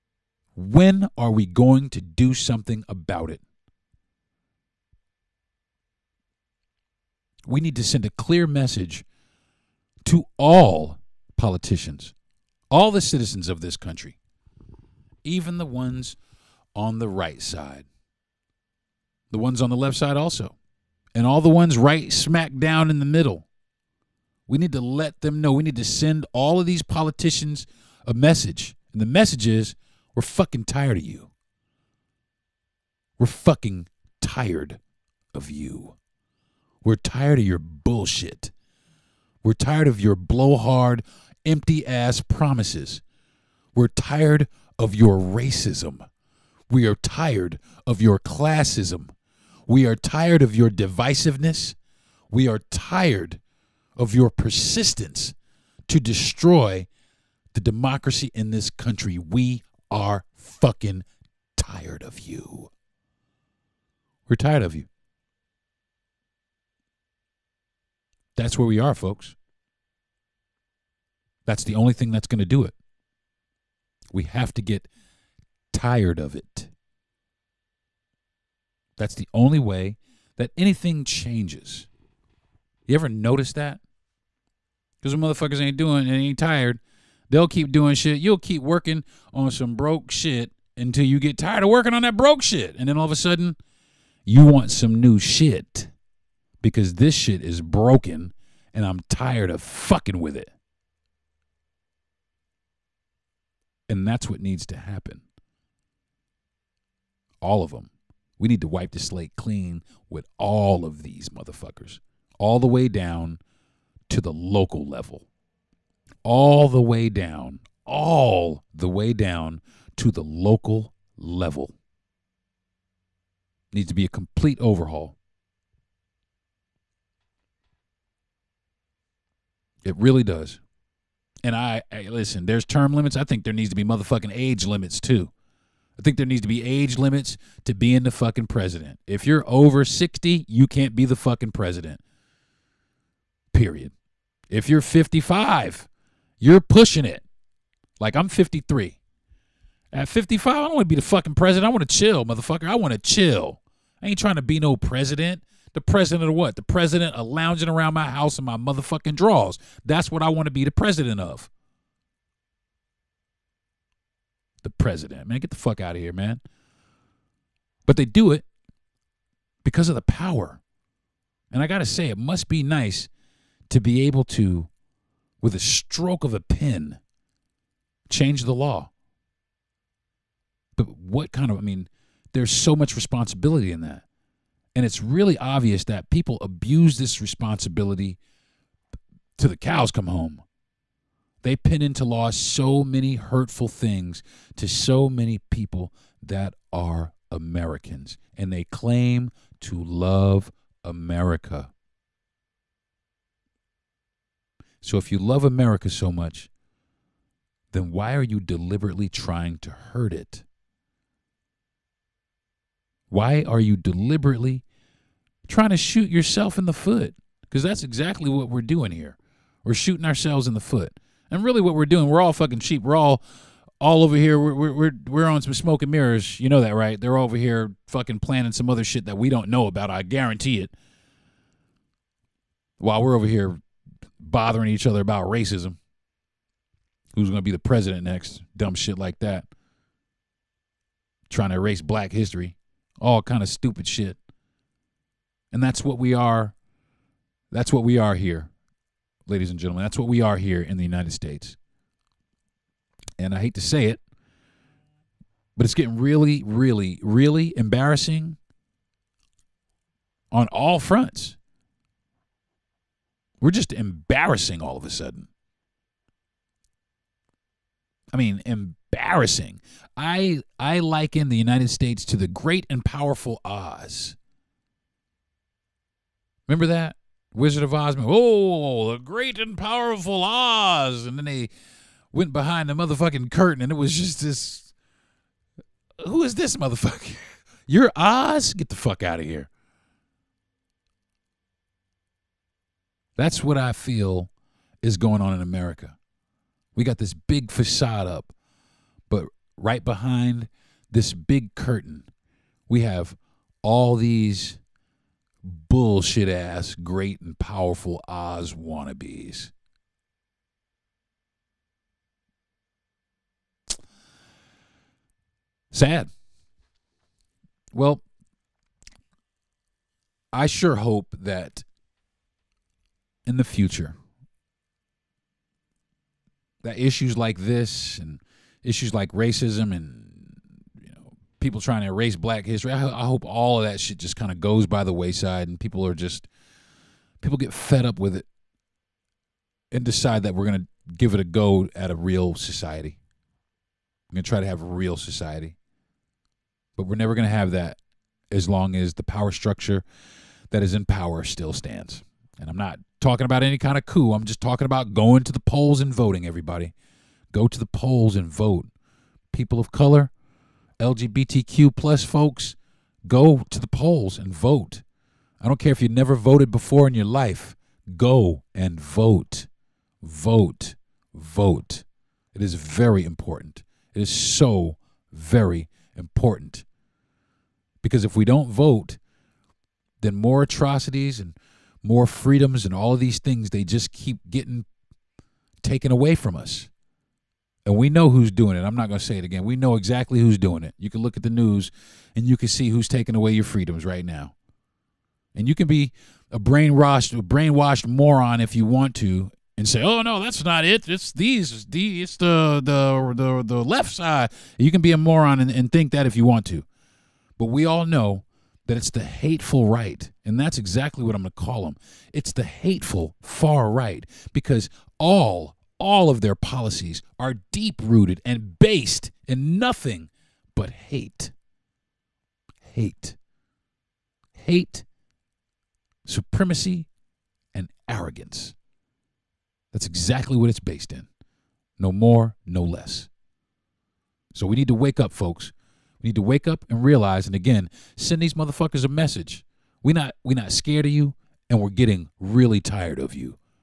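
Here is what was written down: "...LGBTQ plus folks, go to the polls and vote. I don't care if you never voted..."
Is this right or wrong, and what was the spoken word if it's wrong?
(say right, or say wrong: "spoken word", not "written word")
right.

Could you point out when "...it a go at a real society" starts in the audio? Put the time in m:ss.
5:41.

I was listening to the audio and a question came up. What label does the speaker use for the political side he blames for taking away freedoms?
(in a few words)
hateful far right.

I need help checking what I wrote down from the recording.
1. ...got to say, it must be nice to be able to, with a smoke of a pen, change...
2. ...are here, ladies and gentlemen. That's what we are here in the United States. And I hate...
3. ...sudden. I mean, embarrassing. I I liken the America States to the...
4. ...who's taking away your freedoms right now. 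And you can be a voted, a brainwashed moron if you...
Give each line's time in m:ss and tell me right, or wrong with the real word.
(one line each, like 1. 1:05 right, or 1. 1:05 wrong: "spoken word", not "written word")
1. 2:51 wrong: "stroke", not "smoke"
2. 4:07 right
3. 4:24 wrong: "United", not "America"
4. 6:32 wrong: "brainwashed", not "voted".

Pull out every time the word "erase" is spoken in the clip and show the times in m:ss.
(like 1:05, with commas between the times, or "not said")
4:01, 5:31.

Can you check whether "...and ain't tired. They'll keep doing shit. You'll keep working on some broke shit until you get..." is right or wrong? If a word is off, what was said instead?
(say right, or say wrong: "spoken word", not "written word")
right.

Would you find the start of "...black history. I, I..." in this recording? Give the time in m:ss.
5:32.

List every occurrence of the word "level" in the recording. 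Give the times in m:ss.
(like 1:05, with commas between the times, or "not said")
1:54, 2:01.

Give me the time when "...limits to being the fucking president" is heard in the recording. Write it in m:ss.
2:16.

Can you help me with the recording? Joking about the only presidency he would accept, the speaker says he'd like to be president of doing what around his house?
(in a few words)
lounging.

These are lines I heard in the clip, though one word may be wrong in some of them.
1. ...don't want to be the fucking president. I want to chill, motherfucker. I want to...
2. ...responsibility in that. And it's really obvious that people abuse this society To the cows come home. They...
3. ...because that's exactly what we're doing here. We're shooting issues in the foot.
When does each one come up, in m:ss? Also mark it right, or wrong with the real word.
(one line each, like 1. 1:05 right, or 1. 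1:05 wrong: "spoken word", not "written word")
1. 2:30 right
2. 3:02 wrong: "responsibility", not "society"
3. 3:37 wrong: "ourselves", not "issues".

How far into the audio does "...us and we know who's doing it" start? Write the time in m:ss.
6:26.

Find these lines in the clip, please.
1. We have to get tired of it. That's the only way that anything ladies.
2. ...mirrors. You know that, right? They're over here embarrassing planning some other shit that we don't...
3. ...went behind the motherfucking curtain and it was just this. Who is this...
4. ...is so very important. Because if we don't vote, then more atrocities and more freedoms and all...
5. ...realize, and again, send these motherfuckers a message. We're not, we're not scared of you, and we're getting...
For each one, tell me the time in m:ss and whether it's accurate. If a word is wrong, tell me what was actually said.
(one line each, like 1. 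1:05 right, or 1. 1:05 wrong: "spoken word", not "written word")
1. 1:14 wrong: "changes", not "ladies"
2. 3:45 wrong: "fucking", not "embarrassing"
3. 4:42 right
4. 6:14 right
5. 7:16 right.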